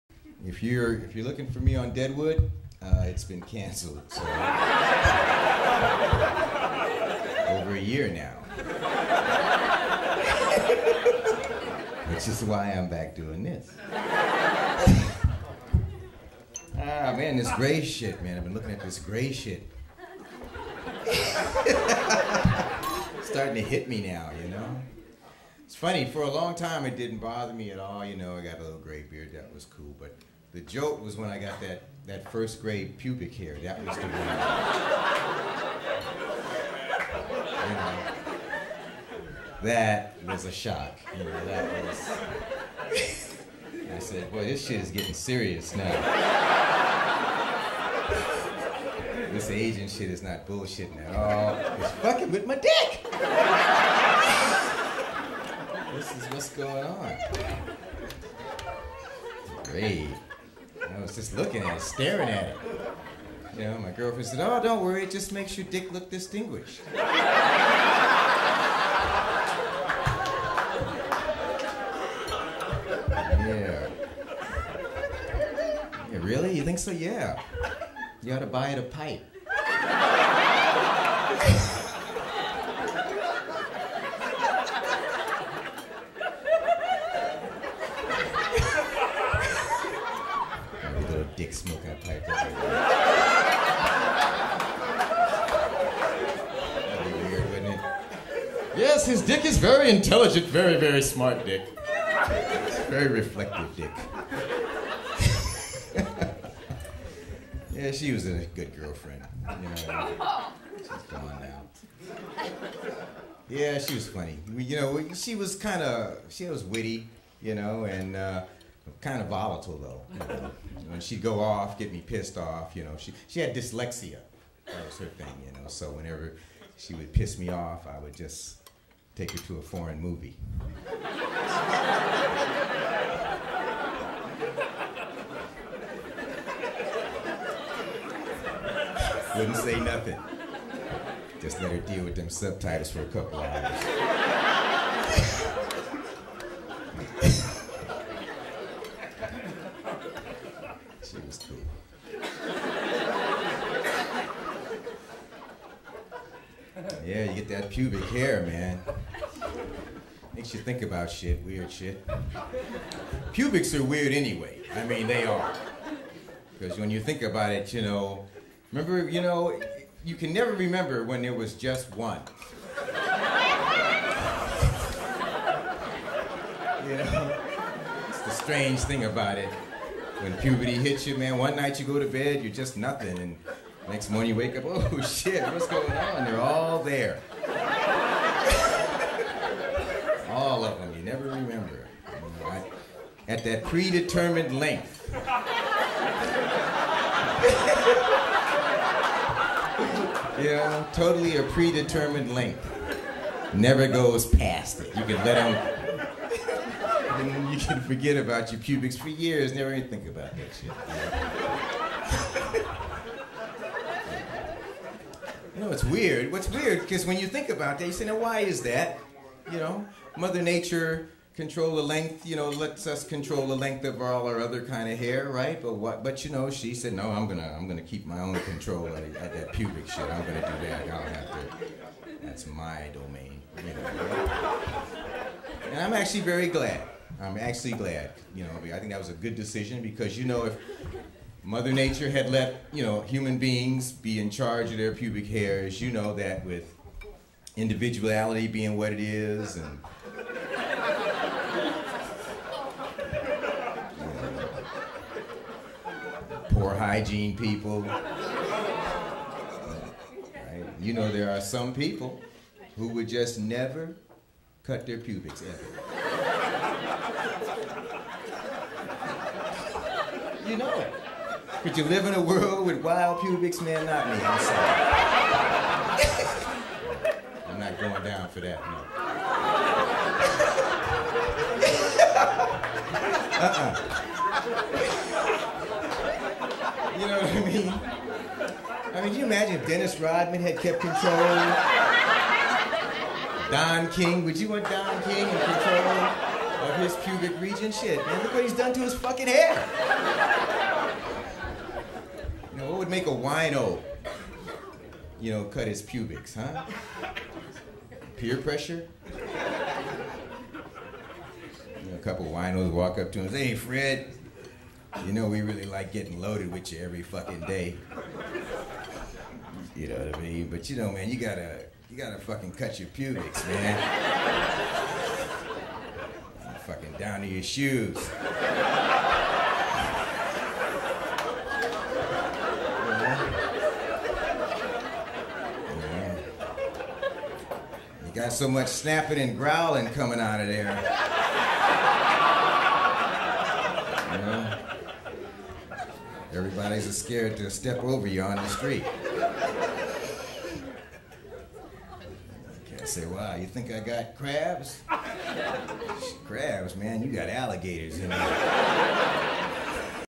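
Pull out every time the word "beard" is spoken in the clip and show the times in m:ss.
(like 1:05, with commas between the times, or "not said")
0:29.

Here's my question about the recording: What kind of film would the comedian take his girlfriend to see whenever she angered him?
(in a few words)
A foreign movie.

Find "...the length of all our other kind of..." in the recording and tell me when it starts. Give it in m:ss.
3:43.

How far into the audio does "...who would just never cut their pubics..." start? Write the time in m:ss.
4:22.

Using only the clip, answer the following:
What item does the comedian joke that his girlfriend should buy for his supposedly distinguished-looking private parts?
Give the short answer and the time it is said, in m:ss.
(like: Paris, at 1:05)
A pipe, at 1:18.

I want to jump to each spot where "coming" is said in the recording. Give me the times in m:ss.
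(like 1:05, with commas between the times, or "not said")
5:39.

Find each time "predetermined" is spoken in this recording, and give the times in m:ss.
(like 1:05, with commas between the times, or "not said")
3:13, 3:21.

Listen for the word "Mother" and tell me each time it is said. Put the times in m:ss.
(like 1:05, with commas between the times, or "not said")
3:40, 4:01.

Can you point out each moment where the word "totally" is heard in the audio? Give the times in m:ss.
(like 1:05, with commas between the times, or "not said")
3:20.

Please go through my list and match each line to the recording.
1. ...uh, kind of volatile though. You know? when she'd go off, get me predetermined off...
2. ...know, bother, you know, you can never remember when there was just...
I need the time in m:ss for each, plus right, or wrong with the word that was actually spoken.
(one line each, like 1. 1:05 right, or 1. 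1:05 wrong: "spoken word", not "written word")
1. 1:58 wrong: "pissed", not "predetermined"
2. 2:47 wrong: "remember", not "bother".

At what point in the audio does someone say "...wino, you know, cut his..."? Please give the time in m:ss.
5:03.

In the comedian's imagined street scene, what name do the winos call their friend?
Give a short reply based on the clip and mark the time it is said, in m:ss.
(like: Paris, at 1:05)
Fred, at 5:13.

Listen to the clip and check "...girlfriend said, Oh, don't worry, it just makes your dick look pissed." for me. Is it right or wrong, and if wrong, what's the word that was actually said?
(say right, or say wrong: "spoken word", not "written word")
wrong: "distinguished", not "pissed".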